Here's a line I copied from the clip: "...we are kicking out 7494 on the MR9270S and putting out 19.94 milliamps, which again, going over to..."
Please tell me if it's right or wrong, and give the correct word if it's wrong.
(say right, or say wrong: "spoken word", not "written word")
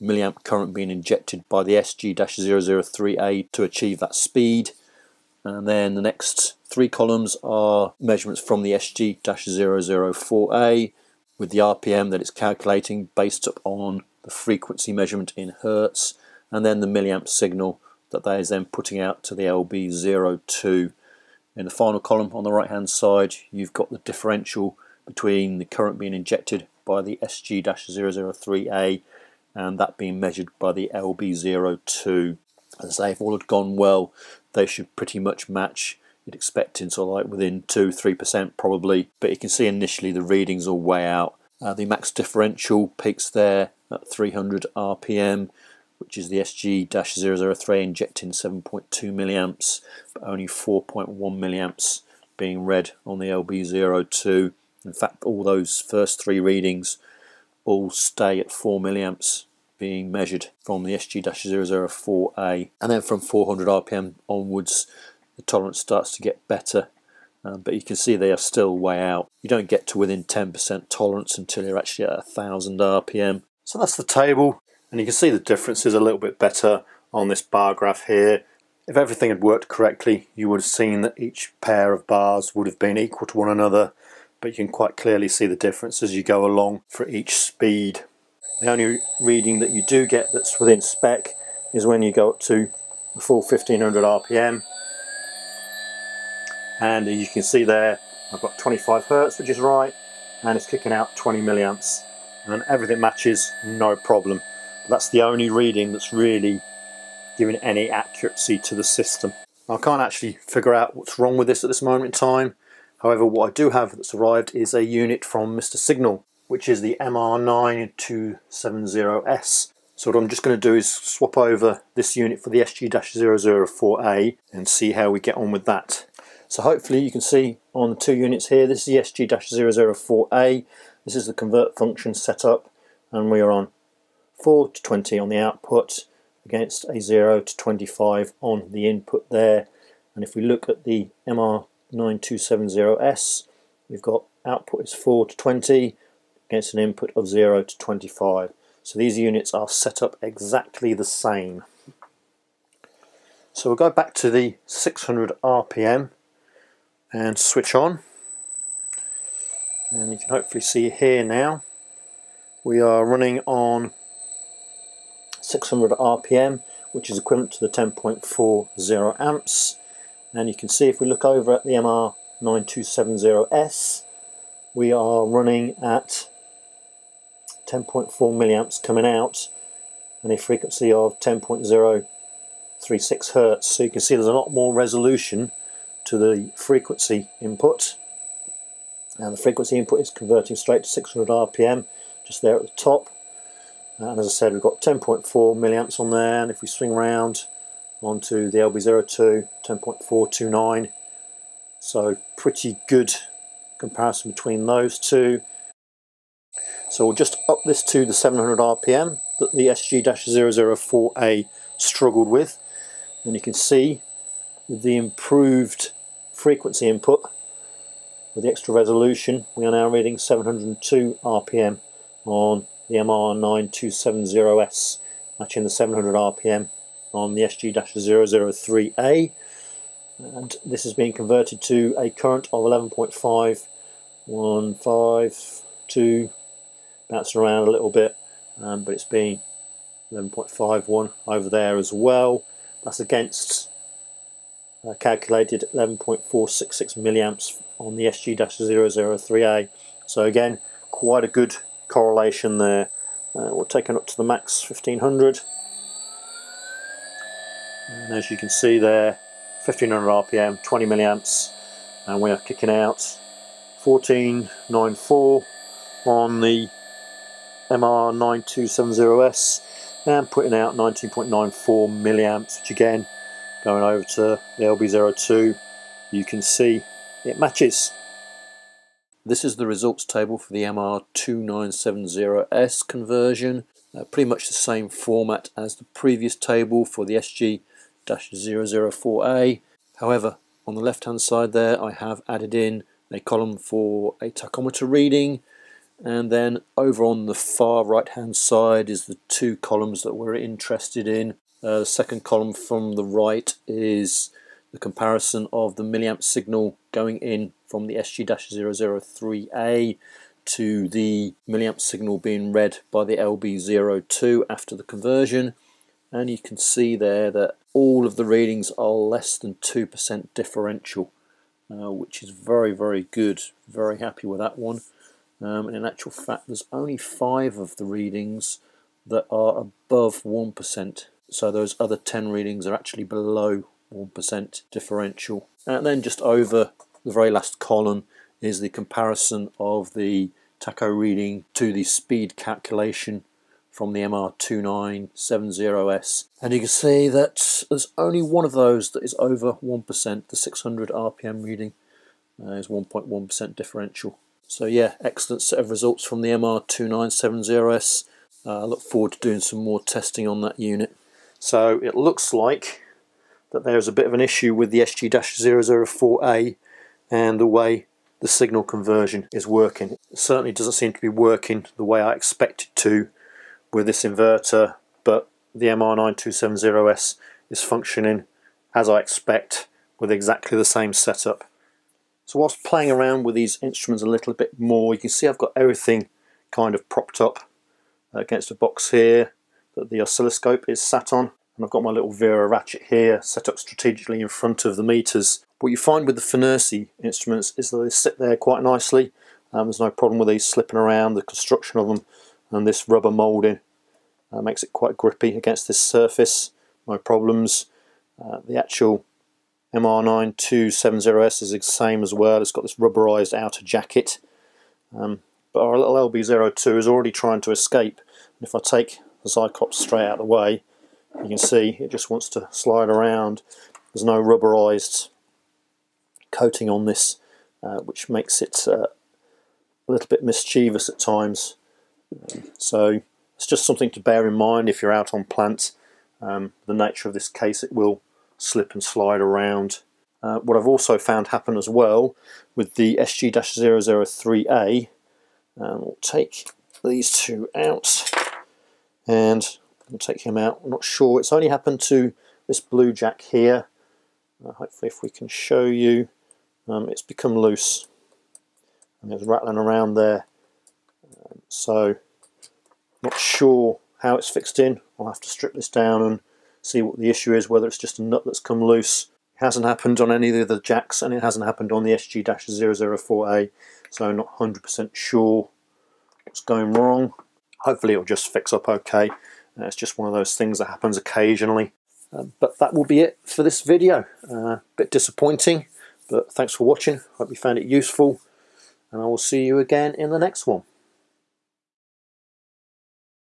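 wrong: "1494", not "7494".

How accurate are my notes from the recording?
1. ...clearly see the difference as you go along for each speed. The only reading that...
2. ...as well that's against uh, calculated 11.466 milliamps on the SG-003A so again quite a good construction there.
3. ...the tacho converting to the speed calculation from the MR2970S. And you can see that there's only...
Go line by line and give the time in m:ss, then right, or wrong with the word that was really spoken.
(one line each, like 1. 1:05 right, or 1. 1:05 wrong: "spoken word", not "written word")
1. 1:24 right
2. 4:01 wrong: "correlation", not "construction"
3. 5:39 wrong: "reading", not "converting".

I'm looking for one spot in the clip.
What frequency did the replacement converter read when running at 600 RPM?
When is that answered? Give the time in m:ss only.
3:01.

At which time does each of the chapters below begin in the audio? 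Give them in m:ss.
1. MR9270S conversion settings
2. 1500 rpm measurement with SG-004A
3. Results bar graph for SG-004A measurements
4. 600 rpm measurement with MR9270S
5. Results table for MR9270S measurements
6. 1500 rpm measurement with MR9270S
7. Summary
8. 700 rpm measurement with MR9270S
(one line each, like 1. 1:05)
1. 2:05
2. 1:30
3. 1:13
4. 2:31
5. 4:37
6. 4:12
7. 6:01
8. 3:27.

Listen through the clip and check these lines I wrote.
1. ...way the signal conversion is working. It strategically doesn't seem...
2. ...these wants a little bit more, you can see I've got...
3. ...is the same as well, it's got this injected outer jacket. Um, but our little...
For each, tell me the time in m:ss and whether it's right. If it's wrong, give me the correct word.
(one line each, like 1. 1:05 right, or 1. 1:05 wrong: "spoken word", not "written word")
1. 6:07 wrong: "certainly", not "strategically"
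2. 6:23 wrong: "instruments", not "wants"
3. 6:51 wrong: "rubberized", not "injected".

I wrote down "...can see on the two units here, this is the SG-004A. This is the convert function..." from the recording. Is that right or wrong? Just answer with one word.
right.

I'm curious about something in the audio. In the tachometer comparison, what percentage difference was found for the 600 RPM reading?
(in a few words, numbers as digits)
1.1%.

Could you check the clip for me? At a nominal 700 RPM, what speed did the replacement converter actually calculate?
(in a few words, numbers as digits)
702 RPM.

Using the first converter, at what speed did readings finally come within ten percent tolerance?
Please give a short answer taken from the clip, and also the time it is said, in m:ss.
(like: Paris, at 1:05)
1000 RPM, at 1:12.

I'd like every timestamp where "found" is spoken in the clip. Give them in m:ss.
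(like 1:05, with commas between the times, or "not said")
7:20, 8:07.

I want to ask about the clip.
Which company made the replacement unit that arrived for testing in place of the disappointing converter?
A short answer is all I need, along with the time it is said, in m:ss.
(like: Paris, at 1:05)
Mr. Signal, at 1:55.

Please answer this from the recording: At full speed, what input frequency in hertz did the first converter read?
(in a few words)
25 Hertz.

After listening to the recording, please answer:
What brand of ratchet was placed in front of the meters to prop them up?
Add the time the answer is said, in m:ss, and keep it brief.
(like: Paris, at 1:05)
Wera, at 6:32.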